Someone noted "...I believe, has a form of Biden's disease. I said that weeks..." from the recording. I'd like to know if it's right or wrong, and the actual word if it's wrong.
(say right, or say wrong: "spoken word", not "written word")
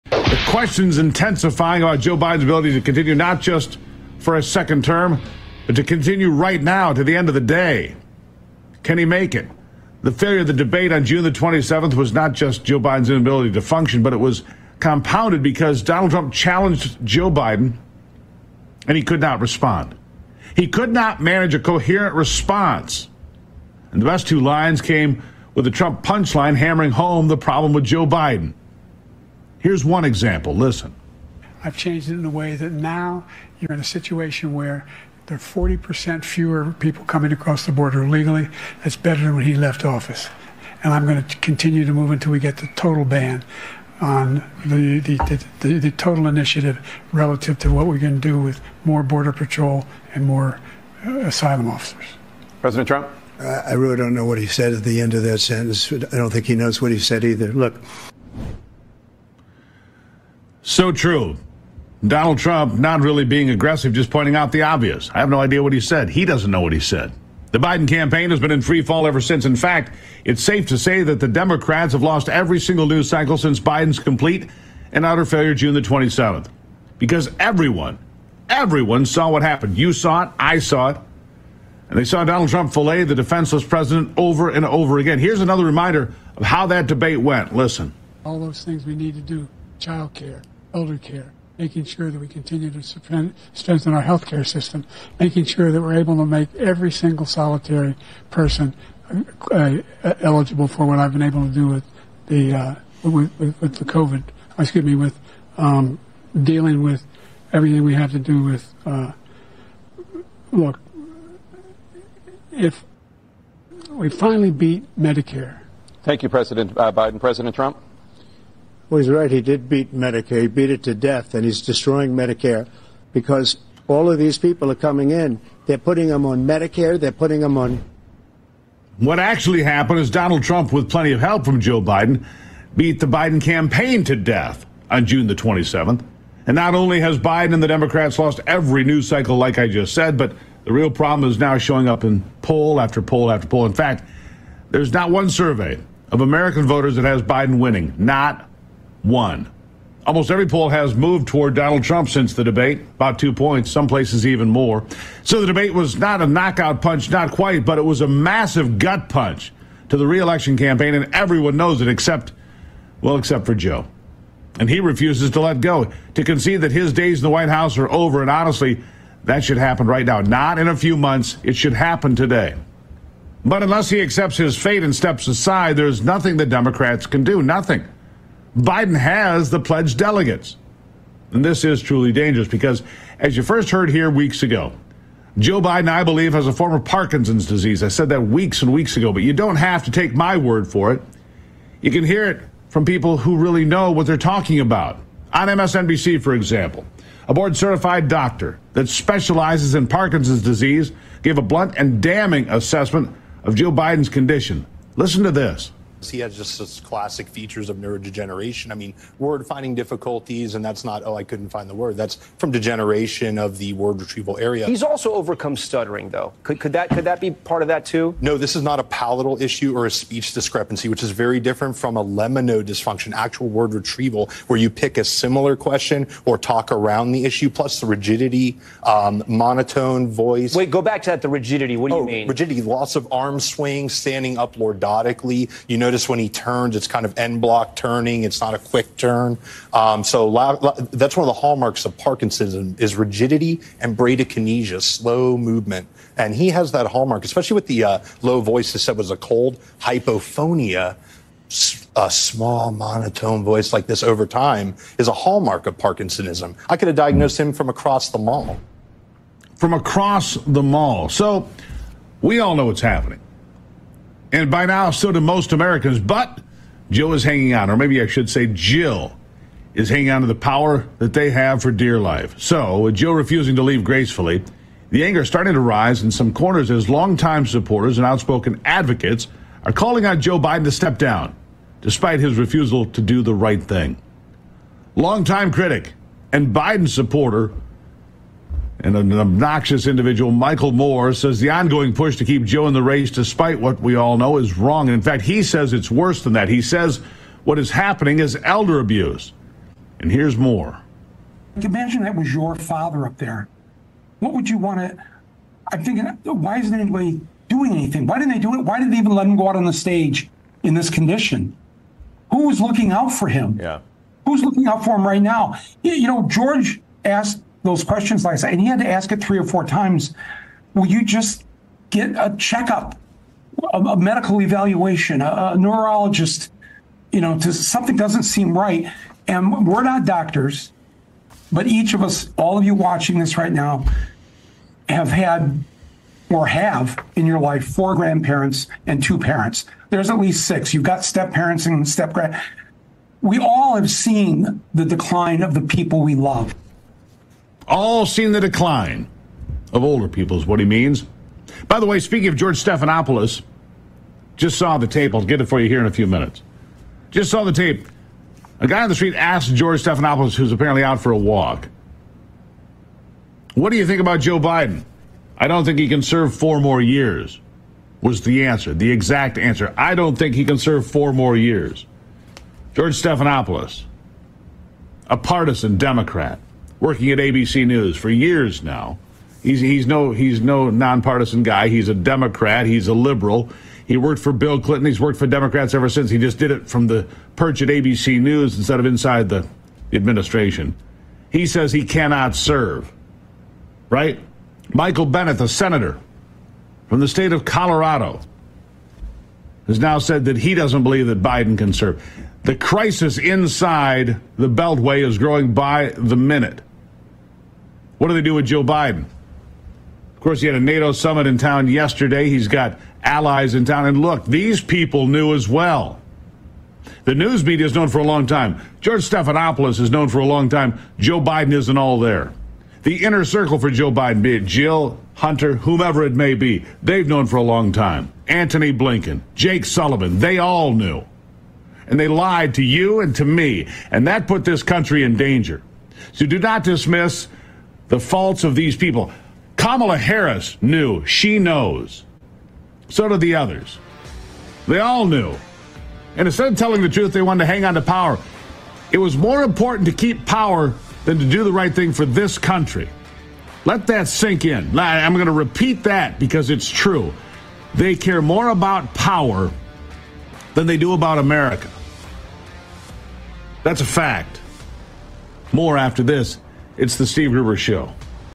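wrong: "Parkinson", not "Biden".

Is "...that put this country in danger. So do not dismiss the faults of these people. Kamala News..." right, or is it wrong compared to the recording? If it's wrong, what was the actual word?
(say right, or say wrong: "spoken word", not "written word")
wrong: "Harris", not "News".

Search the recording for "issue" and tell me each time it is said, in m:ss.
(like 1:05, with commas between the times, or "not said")
3:39, 3:47.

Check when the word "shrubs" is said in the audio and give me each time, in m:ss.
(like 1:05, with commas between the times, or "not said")
not said.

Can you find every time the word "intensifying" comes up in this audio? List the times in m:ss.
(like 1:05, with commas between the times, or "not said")
0:00.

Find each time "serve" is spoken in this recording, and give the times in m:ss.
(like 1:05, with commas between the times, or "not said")
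6:06, 6:10, 6:32, 6:41.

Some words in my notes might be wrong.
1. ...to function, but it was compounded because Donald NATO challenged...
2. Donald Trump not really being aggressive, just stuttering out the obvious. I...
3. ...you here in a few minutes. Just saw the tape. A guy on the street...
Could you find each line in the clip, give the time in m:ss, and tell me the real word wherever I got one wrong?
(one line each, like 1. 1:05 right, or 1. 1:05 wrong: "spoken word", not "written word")
1. 0:13 wrong: "Trump", not "NATO"
2. 1:02 wrong: "pointing", not "stuttering"
3. 5:55 right.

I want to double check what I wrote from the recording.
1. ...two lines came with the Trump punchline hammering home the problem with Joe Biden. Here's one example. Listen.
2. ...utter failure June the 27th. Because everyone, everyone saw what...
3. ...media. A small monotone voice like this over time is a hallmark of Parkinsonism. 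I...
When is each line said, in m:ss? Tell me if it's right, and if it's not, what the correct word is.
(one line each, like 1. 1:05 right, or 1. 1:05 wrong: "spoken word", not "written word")
1. 0:24 right
2. 1:15 right
3. 4:09 wrong: "hypophonia", not "media".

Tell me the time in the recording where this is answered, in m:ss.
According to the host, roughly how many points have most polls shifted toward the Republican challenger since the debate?
2:33.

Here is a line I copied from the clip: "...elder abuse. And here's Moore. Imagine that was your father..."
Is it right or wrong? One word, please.
right.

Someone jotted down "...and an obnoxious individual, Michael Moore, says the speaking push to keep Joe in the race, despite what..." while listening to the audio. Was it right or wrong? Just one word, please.
wrong.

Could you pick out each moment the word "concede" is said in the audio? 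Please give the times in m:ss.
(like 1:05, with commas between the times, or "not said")
2:46.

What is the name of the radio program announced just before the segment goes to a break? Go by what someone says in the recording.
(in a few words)
The Steve Gruber Show.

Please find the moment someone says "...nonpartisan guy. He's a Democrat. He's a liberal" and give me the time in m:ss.
6:20.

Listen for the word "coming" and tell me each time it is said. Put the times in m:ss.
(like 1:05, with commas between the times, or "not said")
0:37, 2:04.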